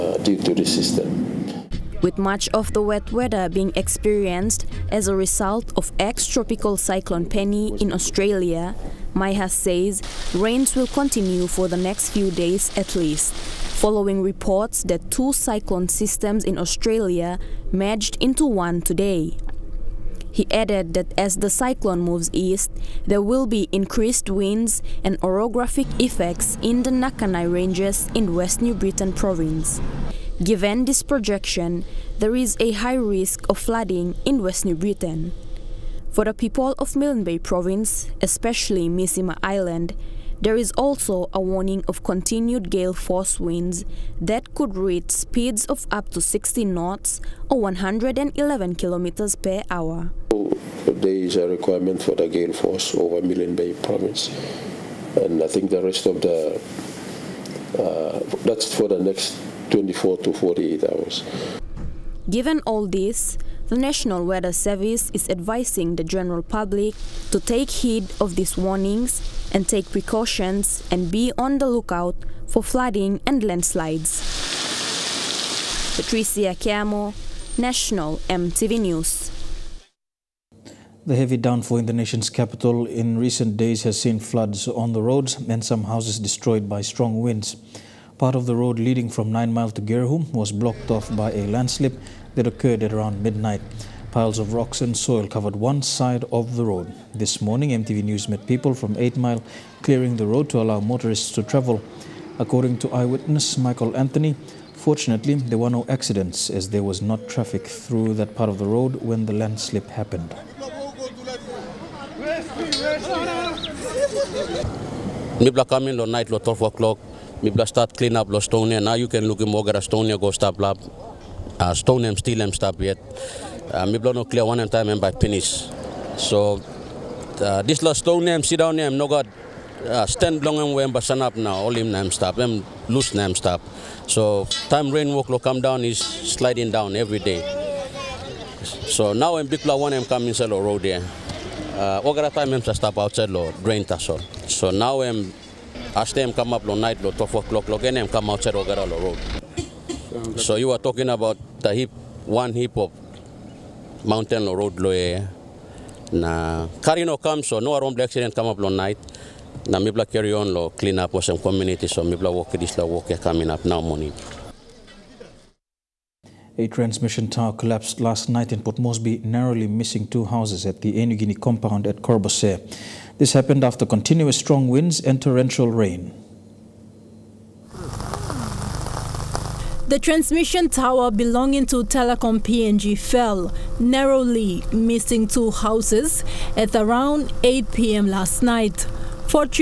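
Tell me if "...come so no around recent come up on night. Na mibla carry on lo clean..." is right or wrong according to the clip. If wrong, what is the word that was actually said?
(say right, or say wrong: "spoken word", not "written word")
wrong: "accident", not "recent".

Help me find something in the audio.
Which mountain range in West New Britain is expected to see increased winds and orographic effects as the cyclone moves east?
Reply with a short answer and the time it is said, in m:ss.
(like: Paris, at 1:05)
Nakanai Ranges, at 0:26.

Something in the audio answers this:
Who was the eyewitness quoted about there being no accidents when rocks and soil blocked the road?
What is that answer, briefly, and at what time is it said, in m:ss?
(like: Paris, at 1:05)
Michael Anthony, at 1:43.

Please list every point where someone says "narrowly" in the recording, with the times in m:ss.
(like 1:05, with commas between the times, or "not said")
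2:49, 3:03.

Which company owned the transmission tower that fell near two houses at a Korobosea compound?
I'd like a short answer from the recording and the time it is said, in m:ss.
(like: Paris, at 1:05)
Telecom PNG, at 3:01.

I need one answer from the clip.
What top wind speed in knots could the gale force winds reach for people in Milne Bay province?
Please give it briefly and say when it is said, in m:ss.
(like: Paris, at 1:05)
60 knots, at 0:46.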